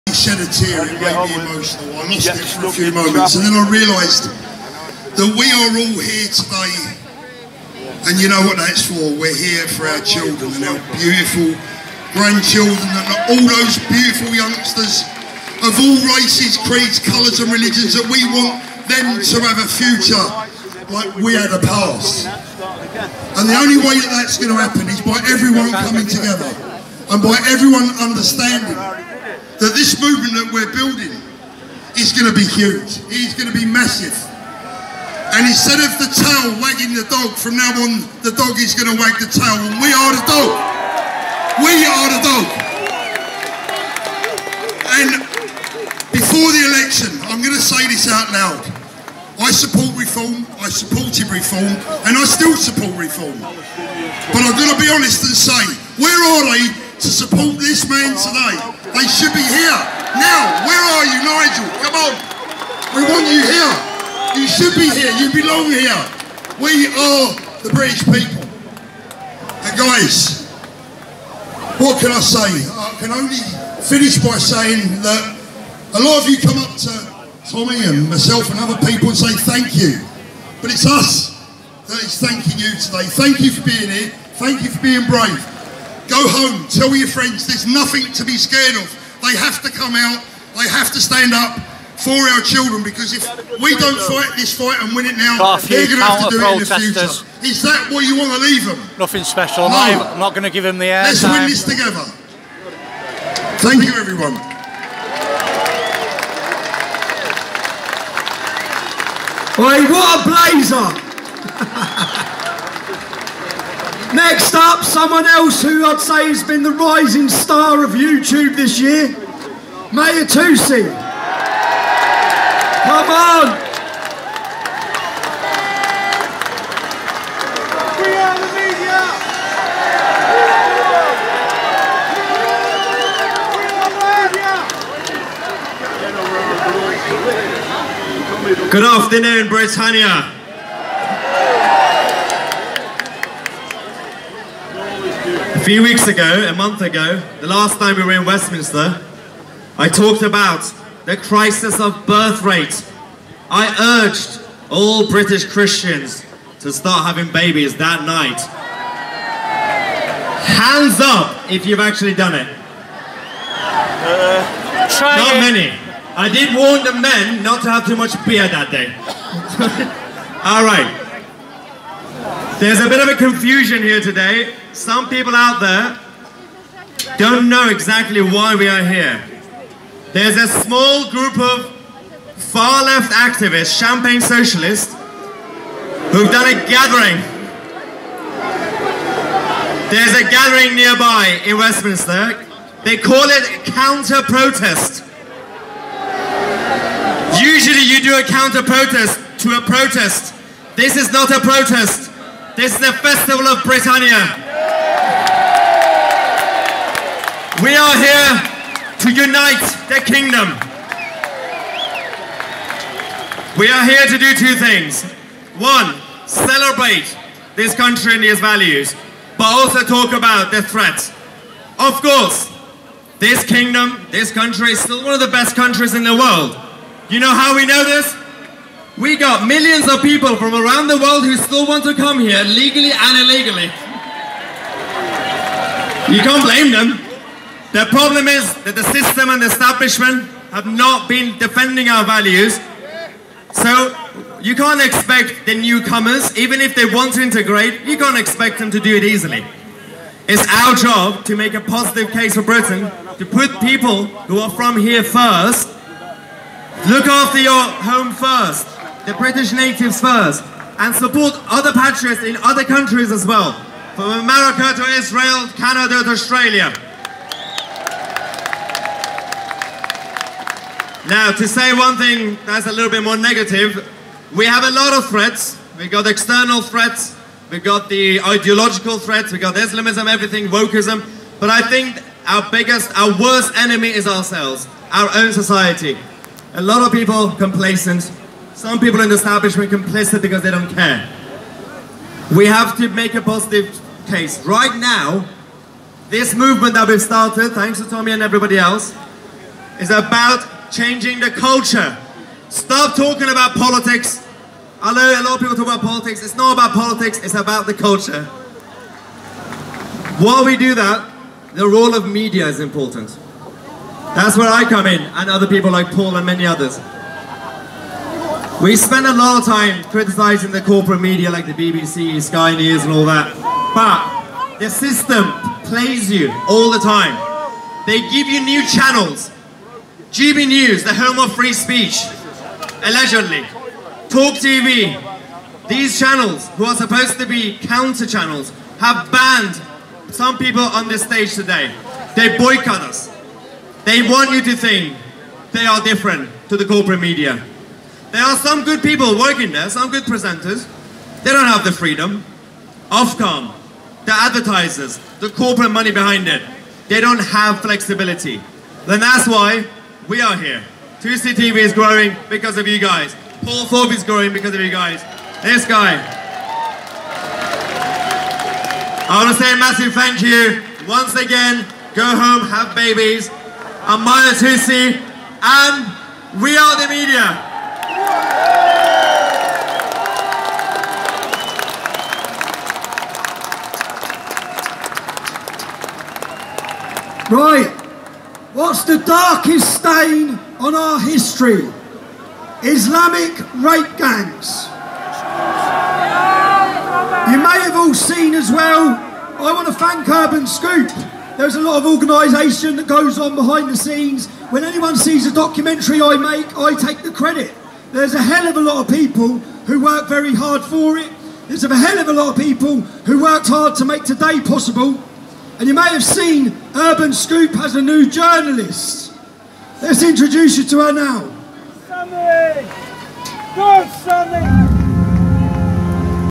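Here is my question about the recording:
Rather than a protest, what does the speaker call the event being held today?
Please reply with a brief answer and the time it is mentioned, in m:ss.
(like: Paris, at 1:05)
festival of Britannia, at 3:22.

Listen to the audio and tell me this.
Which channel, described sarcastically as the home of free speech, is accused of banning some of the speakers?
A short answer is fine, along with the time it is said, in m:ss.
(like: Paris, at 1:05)
GB News, at 5:30.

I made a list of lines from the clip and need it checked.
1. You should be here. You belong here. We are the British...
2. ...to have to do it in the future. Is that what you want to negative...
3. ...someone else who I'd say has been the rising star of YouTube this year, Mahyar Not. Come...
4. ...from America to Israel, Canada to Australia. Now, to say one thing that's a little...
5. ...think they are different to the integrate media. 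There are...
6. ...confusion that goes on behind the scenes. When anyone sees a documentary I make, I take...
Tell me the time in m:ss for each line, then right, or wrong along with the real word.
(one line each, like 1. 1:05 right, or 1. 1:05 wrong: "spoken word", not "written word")
1. 1:04 right
2. 1:35 wrong: "leave", not "negative"
3. 1:54 wrong: "Tousi", not "Not"
4. 4:23 right
5. 5:44 wrong: "corporate", not "integrate"
6. 6:41 wrong: "organisation", not "confusion".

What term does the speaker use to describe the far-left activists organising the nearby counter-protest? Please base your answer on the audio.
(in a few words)
champagne socialists.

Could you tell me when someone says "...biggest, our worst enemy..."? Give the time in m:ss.
4:42.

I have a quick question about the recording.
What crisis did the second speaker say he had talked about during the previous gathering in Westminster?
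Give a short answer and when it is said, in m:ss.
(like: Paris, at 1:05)
birth rate, at 2:32.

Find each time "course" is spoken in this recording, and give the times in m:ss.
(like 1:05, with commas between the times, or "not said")
3:42.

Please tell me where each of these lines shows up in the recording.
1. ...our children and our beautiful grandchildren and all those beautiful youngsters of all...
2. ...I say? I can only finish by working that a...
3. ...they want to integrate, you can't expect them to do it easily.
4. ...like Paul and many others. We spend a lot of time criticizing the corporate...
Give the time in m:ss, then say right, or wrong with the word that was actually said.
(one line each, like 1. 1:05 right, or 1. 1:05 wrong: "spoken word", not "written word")
1. 0:09 right
2. 1:12 wrong: "saying", not "working"
3. 4:06 right
4. 5:15 right.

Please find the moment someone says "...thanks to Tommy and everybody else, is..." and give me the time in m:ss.
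4:57.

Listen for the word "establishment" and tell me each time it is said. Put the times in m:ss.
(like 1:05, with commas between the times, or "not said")
3:59, 4:49.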